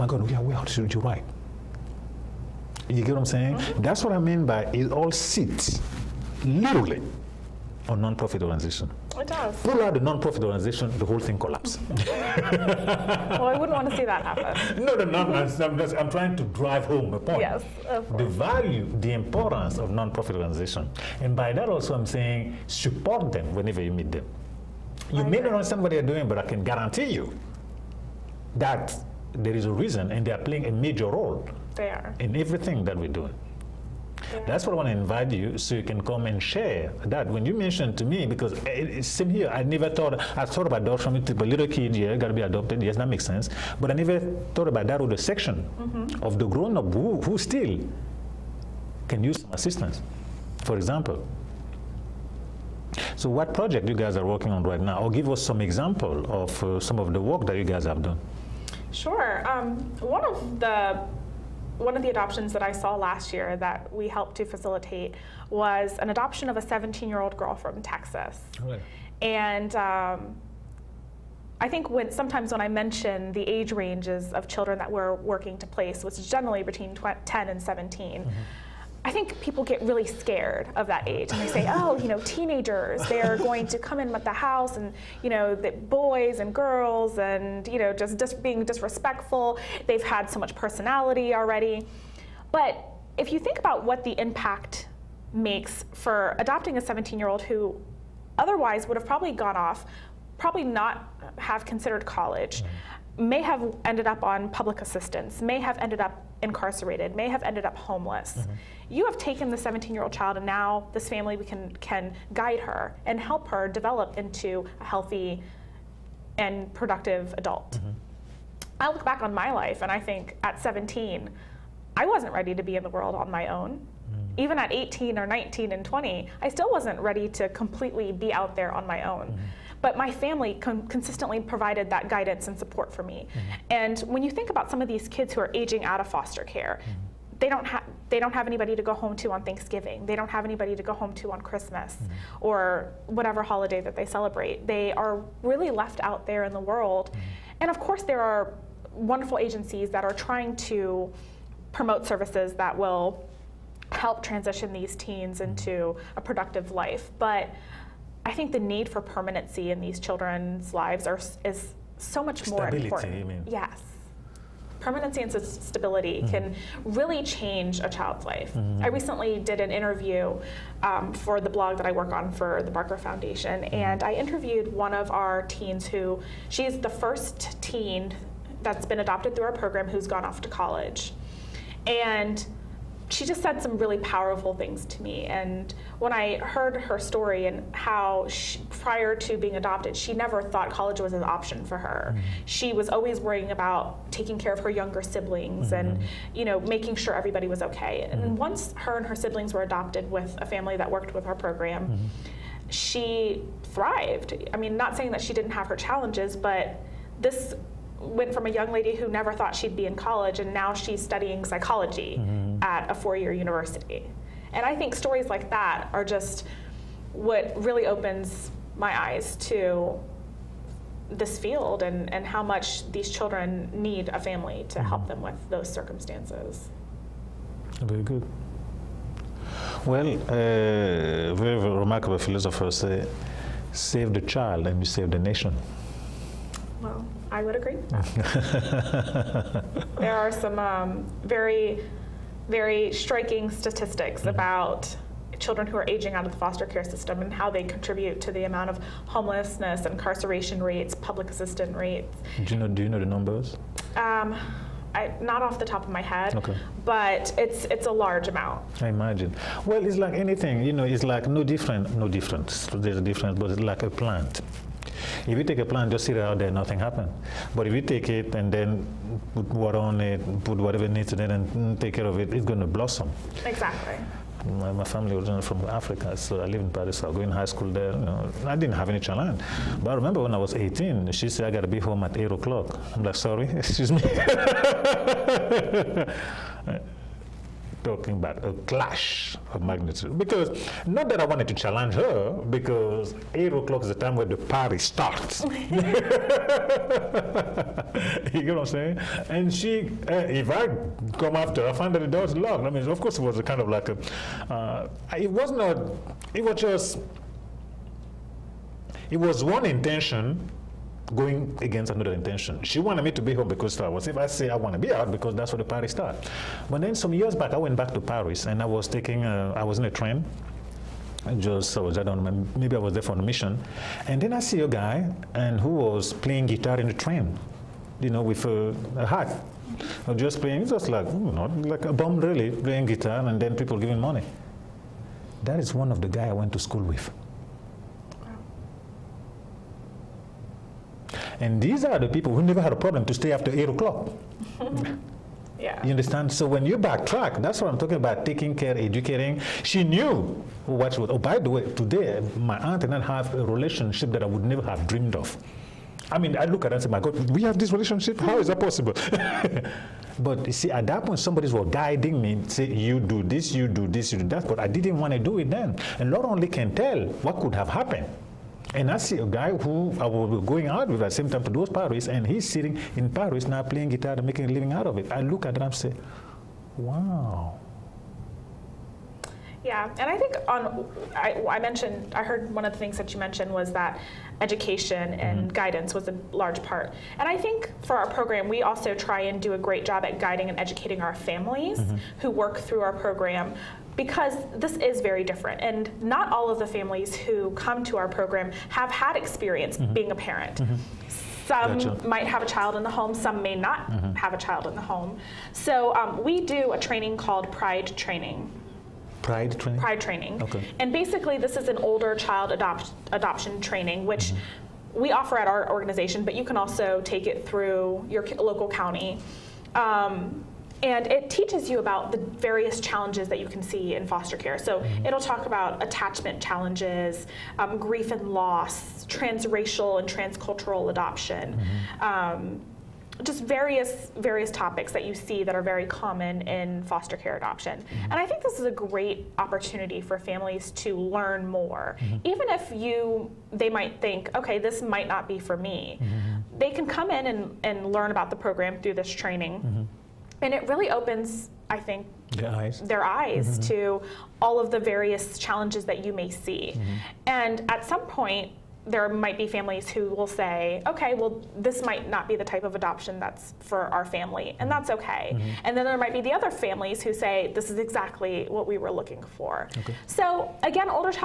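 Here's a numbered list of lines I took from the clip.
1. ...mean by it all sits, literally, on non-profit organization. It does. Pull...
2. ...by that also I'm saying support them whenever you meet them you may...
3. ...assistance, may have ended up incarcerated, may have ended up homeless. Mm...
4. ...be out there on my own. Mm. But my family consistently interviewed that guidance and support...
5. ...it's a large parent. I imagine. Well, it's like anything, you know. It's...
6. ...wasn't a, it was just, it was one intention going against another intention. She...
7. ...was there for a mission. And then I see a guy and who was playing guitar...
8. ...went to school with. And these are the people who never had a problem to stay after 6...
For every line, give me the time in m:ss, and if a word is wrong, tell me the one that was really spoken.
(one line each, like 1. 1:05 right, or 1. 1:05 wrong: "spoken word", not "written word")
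1. 0:04 right
2. 0:21 right
3. 1:44 right
4. 2:08 wrong: "provided", not "interviewed"
5. 4:17 wrong: "amount", not "parent"
6. 5:05 right
7. 5:22 right
8. 5:36 wrong: "8", not "6".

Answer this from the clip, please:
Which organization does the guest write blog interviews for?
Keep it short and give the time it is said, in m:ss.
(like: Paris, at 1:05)
Barker Foundation, at 2:52.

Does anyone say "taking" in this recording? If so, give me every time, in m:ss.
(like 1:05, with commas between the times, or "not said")
3:14, 5:18, 5:48.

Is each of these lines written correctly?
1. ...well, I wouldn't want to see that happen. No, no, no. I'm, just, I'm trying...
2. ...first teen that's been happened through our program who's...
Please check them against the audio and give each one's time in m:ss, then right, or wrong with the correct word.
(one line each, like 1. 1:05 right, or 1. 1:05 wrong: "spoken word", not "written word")
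1. 0:13 right
2. 2:56 wrong: "adopted", not "happened".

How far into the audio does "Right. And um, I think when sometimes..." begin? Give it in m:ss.
1:08.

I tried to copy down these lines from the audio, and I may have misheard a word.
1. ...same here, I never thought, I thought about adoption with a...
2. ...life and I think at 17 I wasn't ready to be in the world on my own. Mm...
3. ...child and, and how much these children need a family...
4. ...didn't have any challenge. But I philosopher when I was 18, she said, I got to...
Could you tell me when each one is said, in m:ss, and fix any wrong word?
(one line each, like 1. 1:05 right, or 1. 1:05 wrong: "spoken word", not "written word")
1. 0:39 right
2. 1:59 right
3. 3:41 wrong: "field", not "child"
4. 4:38 wrong: "remember", not "philosopher".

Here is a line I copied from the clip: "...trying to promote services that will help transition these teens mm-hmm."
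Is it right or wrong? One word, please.
right.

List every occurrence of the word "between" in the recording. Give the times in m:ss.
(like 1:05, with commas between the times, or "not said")
1:16.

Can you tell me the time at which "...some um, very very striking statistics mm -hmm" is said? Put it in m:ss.
4:00.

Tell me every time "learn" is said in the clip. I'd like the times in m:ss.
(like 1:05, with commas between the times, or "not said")
7:20, 7:27.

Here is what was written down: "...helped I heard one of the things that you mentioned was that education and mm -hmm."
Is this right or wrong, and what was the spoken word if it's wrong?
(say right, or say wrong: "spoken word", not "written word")
wrong: "mentioned", not "helped".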